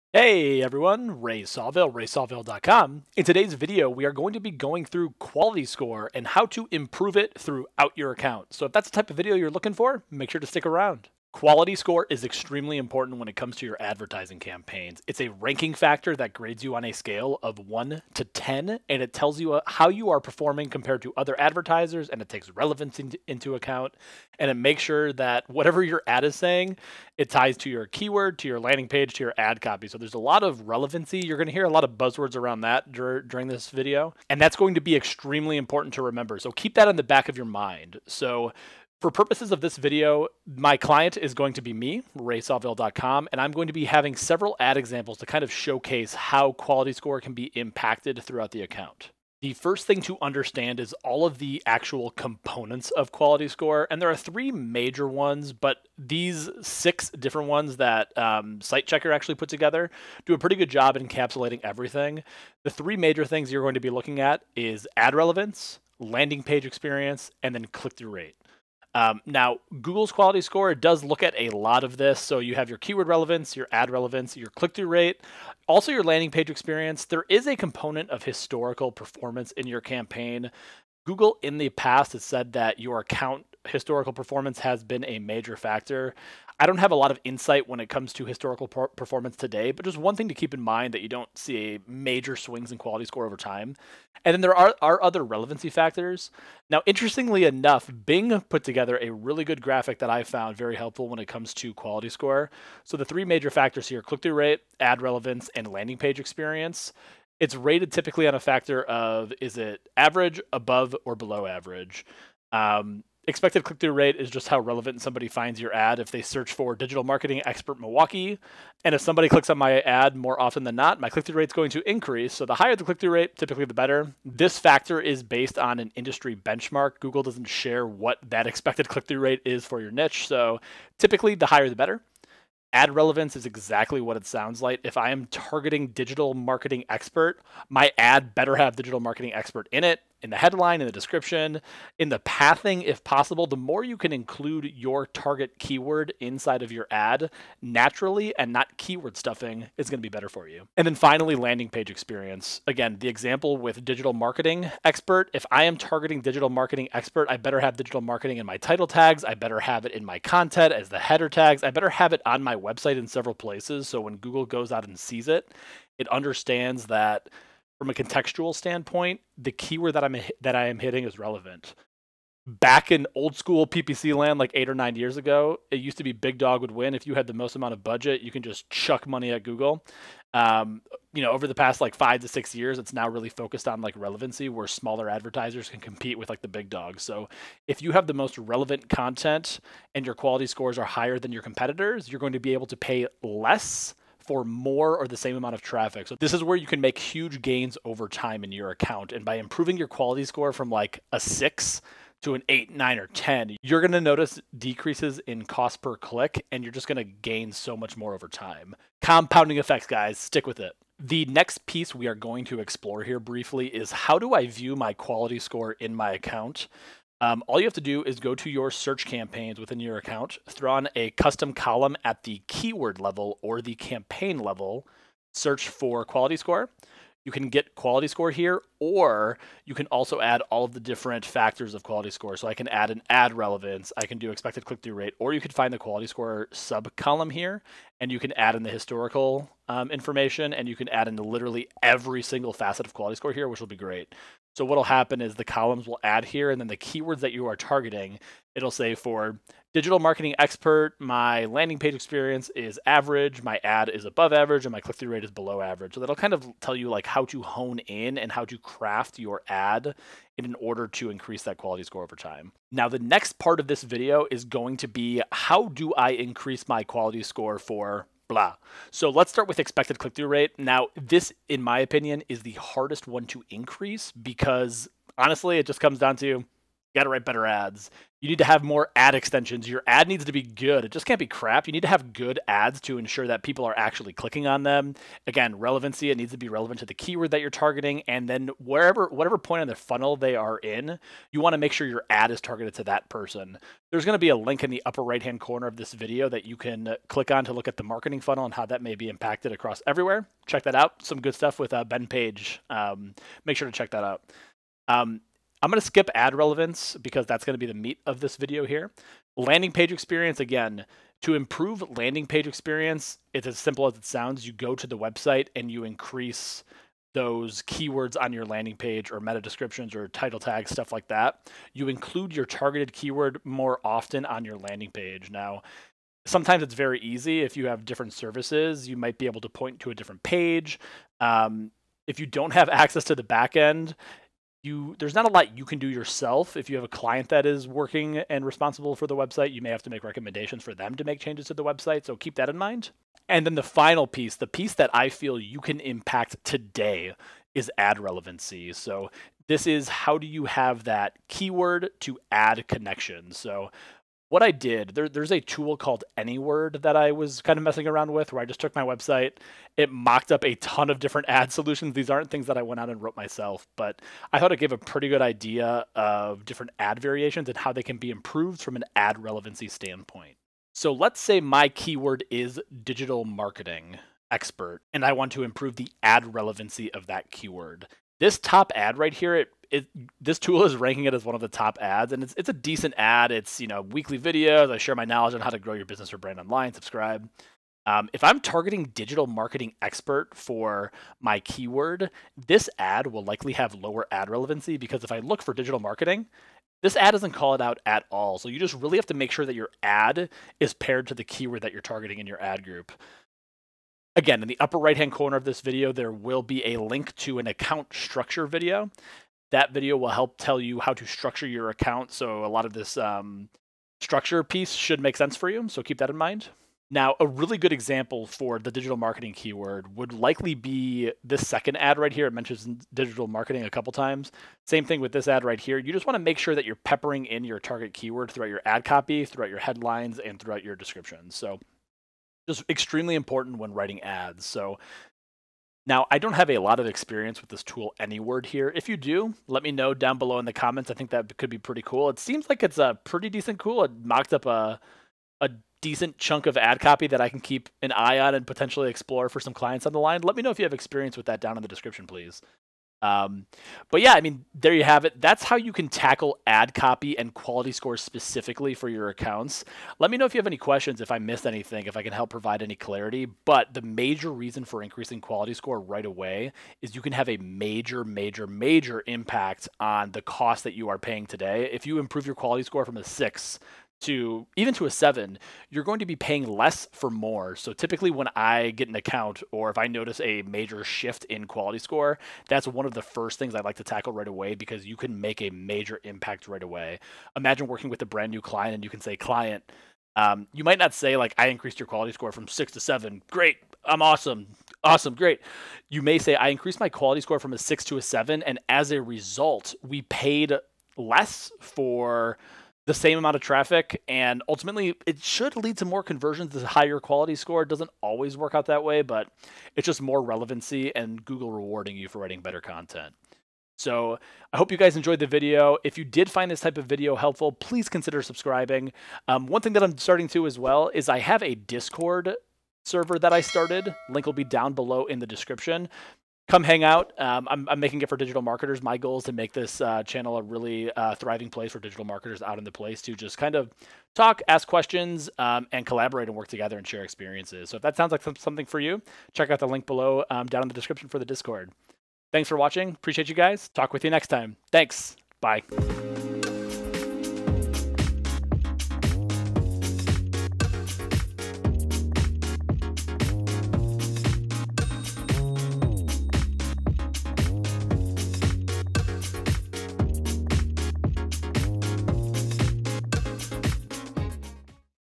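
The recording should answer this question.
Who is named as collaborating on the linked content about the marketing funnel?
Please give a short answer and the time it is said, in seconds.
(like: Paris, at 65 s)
Ben Page, at 301 s.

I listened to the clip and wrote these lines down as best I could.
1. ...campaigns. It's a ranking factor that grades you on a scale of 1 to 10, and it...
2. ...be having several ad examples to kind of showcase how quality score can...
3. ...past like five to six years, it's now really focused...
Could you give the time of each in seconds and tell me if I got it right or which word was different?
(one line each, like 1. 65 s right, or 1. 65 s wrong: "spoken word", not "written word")
1. 14 s right
2. 43 s right
3. 181 s right.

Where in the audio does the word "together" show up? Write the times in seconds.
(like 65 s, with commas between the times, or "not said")
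59 s, 98 s, 536 s.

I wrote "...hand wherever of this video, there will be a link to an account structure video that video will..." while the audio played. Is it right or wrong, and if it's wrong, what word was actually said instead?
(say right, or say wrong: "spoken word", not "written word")
wrong: "corner", not "wherever".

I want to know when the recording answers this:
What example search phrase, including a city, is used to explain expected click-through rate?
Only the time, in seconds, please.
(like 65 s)
116 s.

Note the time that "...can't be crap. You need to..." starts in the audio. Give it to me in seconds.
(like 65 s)
281 s.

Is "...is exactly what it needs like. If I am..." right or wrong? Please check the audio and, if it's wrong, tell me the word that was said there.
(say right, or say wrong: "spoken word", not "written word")
wrong: "sounds", not "needs".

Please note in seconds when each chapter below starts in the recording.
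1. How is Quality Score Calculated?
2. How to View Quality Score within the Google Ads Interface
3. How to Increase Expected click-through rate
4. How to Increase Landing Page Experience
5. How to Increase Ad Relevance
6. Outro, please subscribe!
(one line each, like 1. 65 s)
1. 48 s
2. 212 s
3. 270 s
4. 310 s
5. 343 s
6. 461 s.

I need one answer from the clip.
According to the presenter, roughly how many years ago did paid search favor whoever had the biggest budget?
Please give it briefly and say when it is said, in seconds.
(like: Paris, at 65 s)
8 or 9 years, at 174 s.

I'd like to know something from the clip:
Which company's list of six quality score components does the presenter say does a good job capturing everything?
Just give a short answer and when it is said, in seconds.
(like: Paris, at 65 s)
SiteChecker, at 58 s.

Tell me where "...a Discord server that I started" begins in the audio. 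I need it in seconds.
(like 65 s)
521 s.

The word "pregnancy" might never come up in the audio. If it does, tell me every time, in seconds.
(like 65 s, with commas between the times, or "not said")
not said.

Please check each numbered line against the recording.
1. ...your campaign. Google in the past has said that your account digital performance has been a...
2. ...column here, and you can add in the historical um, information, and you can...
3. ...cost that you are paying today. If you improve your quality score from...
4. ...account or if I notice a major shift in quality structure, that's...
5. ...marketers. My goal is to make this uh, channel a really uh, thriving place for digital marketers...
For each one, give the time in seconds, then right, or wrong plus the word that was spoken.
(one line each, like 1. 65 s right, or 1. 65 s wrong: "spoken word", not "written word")
1. 79 s wrong: "historical", not "digital"
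2. 236 s right
3. 470 s right
4. 478 s wrong: "score", not "structure"
5. 528 s right.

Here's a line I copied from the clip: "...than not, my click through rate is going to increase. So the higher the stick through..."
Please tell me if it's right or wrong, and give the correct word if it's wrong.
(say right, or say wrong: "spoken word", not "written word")
wrong: "click", not "stick".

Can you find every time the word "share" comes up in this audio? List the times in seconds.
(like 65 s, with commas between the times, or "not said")
127 s, 384 s, 536 s.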